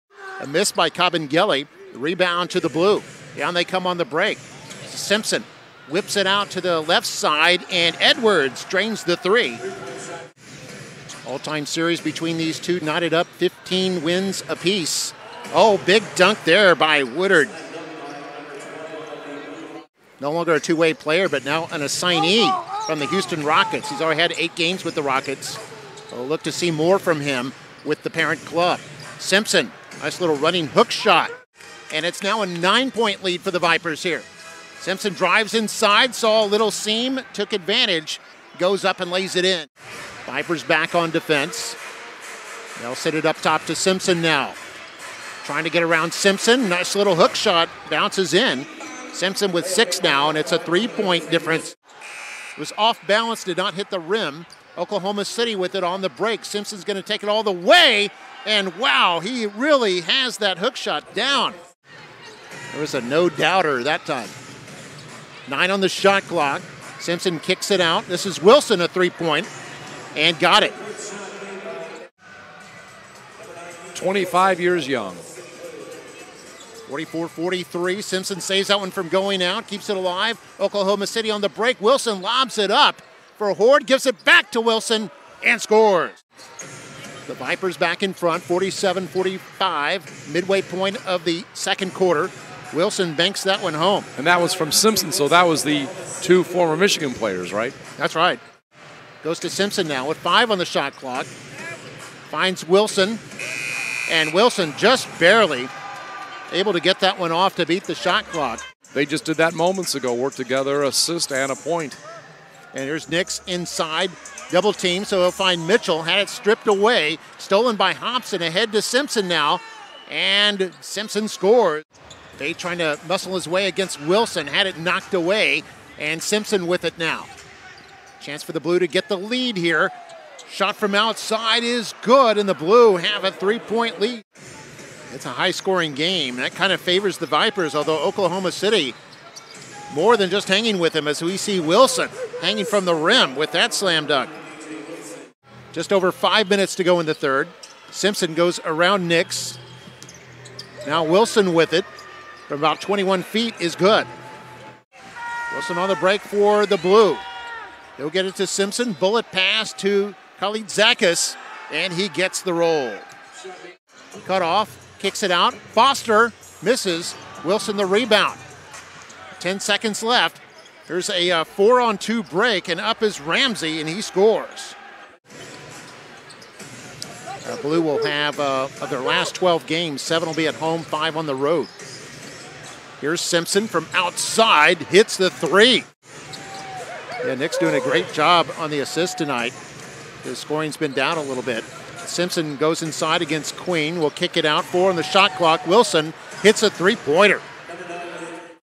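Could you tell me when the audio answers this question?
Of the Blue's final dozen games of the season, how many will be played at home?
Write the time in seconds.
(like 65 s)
180 s.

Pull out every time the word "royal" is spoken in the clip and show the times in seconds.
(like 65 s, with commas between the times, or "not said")
not said.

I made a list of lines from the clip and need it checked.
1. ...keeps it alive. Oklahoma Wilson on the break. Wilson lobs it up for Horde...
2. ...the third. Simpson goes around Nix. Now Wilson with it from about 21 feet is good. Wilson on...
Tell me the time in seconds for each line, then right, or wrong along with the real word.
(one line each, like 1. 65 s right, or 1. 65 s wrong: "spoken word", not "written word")
1. 79 s wrong: "City", not "Wilson"
2. 147 s right.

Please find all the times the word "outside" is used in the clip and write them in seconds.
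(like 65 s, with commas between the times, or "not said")
130 s, 183 s.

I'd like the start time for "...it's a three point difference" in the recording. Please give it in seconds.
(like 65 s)
50 s.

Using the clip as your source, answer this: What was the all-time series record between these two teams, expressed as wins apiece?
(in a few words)
15.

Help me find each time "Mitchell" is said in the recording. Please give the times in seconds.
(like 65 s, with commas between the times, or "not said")
115 s.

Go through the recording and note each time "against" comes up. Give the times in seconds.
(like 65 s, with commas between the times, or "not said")
123 s, 193 s.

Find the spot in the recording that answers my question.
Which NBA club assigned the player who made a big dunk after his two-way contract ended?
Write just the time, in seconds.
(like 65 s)
23 s.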